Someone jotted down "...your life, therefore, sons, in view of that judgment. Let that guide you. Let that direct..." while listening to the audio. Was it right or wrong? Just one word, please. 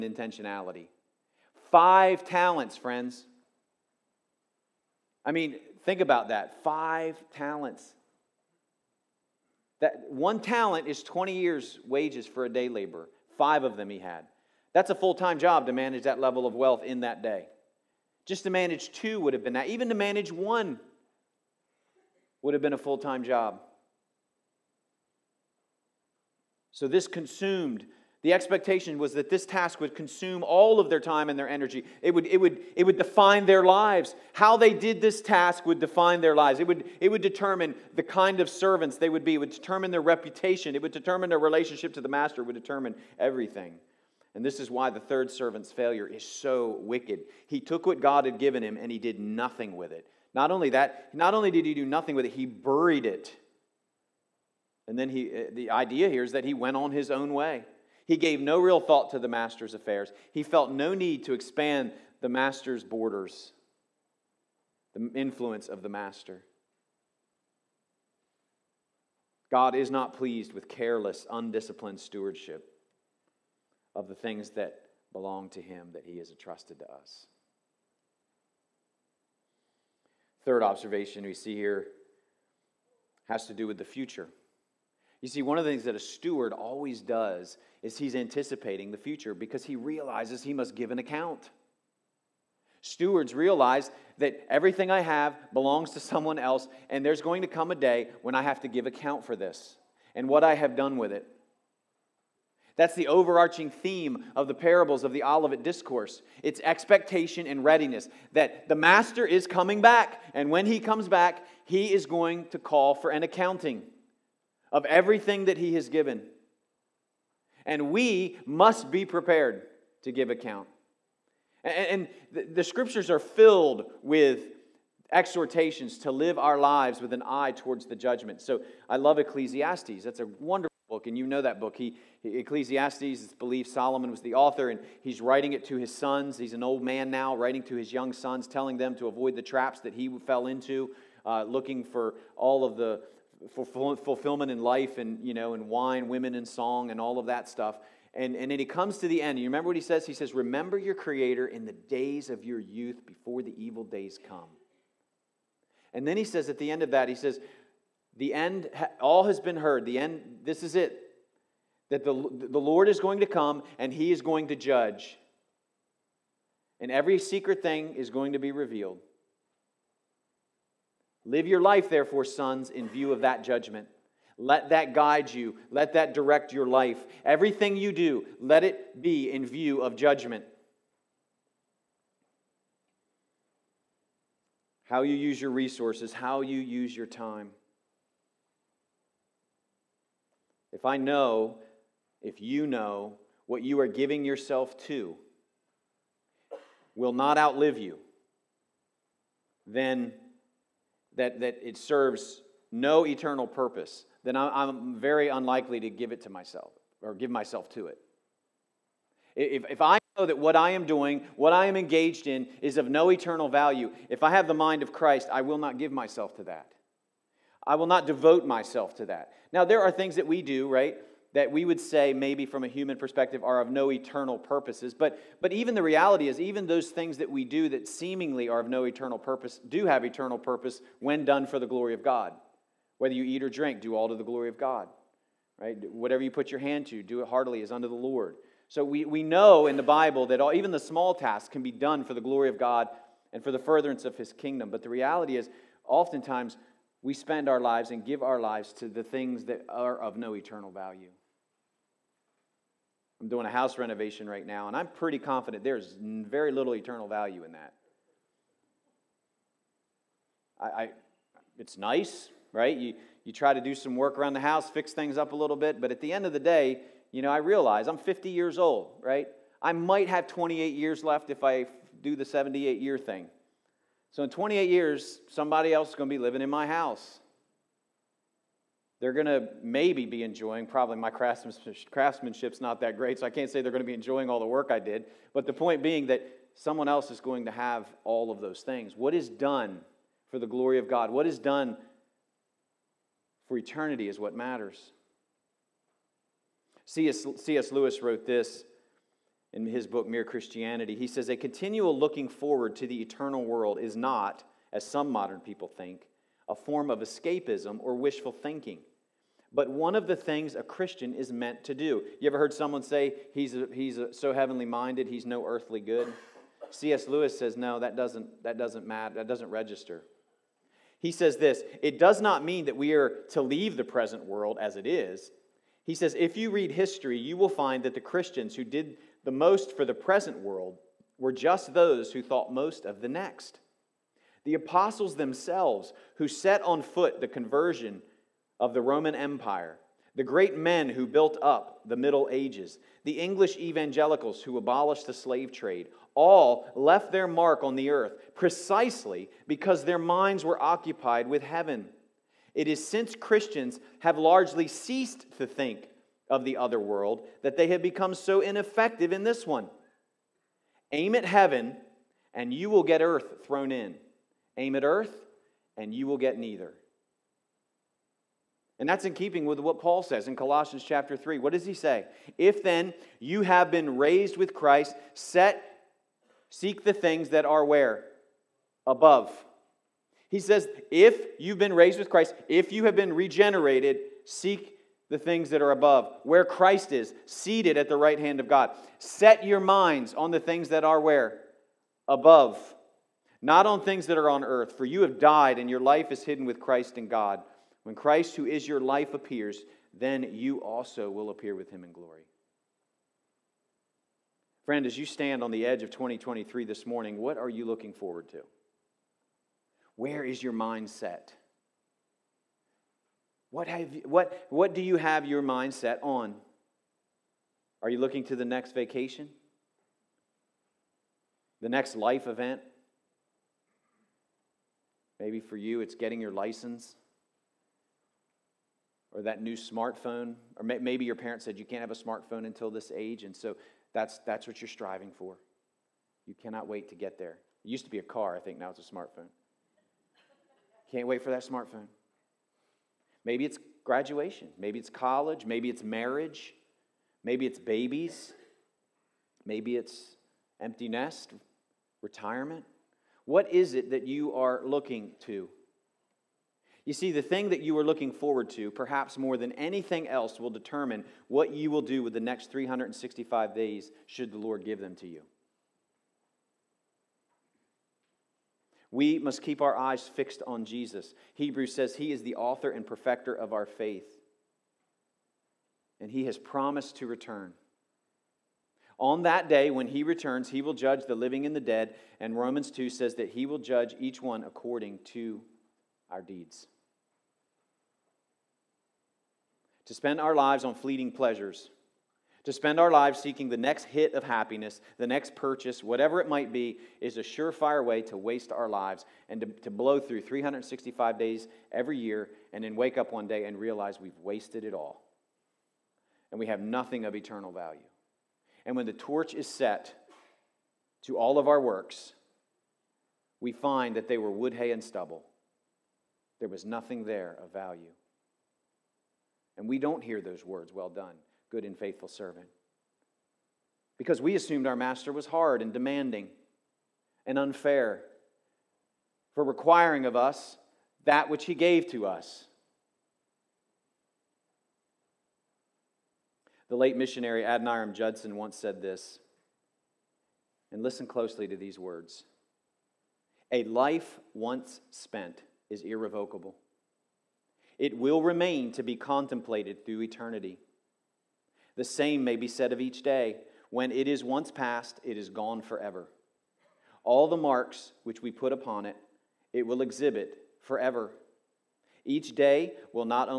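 right.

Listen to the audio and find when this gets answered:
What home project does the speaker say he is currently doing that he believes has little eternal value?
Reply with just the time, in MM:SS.
04:13.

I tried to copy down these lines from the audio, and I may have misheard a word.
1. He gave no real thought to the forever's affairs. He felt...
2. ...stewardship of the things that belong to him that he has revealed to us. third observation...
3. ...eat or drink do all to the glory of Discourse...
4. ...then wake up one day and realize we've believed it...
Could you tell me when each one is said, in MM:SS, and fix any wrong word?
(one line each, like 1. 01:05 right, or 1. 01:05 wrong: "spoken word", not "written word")
1. 00:58 wrong: "master", not "forever"
2. 01:11 wrong: "entrusted", not "revealed"
3. 03:53 wrong: "God", not "Discourse"
4. 08:22 wrong: "wasted", not "believed".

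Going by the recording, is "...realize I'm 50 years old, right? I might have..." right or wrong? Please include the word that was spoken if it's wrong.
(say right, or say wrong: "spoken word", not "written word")
right.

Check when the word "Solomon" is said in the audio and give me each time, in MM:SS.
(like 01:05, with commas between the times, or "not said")
02:13.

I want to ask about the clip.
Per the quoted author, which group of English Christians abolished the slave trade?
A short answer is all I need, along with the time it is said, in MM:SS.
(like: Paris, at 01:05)
English evangelicals, at 05:43.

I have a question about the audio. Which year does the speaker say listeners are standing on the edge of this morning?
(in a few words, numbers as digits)
2023.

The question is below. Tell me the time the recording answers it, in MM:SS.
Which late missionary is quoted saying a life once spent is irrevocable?
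08:57.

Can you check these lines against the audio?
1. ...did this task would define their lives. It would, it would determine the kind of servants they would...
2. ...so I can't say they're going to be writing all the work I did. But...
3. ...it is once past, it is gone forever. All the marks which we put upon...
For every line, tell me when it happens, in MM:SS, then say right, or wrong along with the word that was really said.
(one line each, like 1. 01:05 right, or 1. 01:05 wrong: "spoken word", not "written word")
1. 00:34 right
2. 04:43 wrong: "enjoying", not "writing"
3. 09:13 right.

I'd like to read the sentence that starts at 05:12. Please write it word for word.
You ever heard someone say, he's, a, he's a, so heavenly minded, he's no earthly good?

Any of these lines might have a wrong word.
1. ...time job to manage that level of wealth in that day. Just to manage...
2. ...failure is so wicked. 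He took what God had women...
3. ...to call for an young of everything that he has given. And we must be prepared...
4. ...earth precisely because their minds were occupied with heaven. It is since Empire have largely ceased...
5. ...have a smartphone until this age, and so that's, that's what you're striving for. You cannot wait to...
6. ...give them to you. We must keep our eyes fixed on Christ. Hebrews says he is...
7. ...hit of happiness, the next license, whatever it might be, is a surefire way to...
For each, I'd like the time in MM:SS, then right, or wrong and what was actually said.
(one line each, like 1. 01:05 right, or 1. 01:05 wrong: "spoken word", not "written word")
1. 00:15 right
2. 00:45 wrong: "given", not "women"
3. 01:52 wrong: "accounting", not "young"
4. 05:47 wrong: "Christians", not "Empire"
5. 07:11 right
6. 07:44 wrong: "Jesus", not "Christ"
7. 08:13 wrong: "purchase", not "license".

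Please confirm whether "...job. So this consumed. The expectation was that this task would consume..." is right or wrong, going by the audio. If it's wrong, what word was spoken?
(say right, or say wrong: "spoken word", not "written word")
right.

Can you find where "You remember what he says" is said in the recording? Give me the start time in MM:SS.
02:29.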